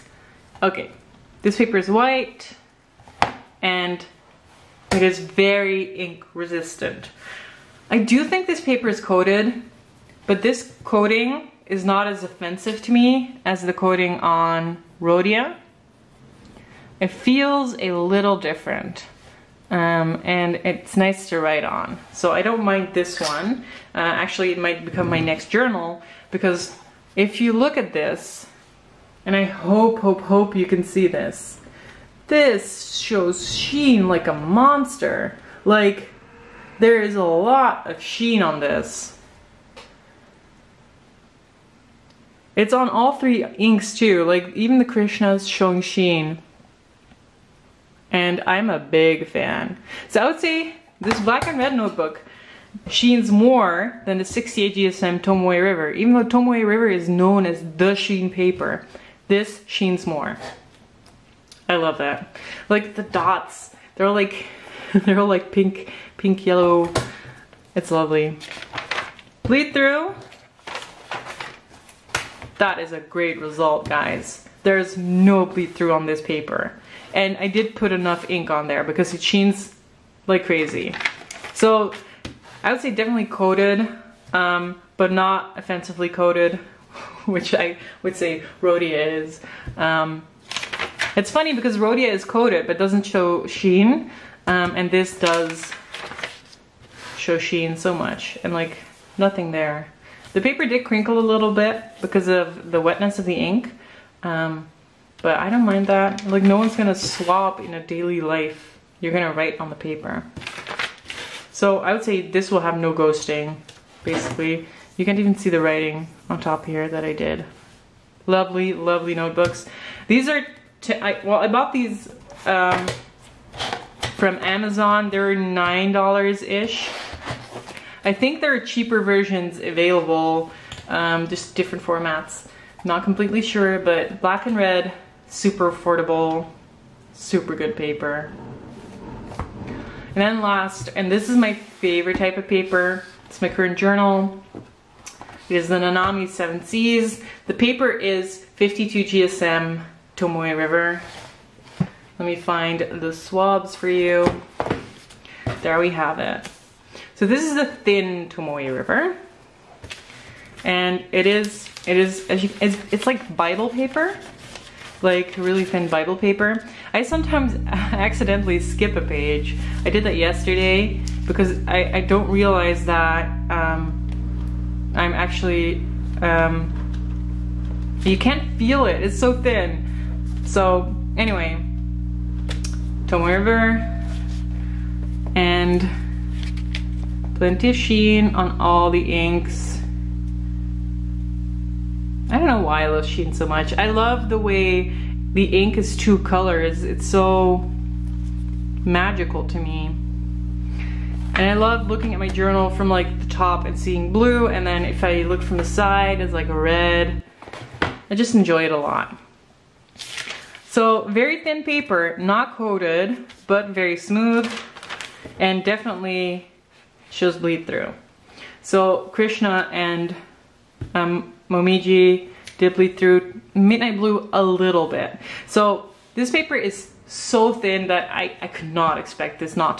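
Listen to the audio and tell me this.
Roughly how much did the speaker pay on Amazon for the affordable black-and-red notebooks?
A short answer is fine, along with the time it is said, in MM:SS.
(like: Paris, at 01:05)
$9, at 02:05.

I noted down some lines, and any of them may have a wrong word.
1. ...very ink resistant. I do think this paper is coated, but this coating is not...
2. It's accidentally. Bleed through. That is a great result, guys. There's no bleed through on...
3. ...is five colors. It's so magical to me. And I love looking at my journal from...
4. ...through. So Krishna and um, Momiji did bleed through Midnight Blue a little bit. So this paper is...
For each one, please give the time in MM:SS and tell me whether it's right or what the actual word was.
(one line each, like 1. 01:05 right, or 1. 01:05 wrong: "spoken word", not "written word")
1. 00:05 right
2. 01:07 wrong: "lovely", not "accidentally"
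3. 03:15 wrong: "two", not "five"
4. 03:37 right.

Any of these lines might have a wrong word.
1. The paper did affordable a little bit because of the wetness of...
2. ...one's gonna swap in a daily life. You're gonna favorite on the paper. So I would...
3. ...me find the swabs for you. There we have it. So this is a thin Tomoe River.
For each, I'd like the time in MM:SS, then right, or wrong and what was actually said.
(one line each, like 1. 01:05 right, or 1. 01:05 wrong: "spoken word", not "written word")
1. 01:40 wrong: "crinkle", not "affordable"
2. 01:46 wrong: "write", not "favorite"
3. 02:32 right.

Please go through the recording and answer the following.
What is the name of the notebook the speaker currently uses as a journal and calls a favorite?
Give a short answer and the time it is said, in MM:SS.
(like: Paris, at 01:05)
Nanami Seven Seas, at 02:25.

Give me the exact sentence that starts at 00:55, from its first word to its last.
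Even though Tomoe River is known as the sheen paper, this sheens more.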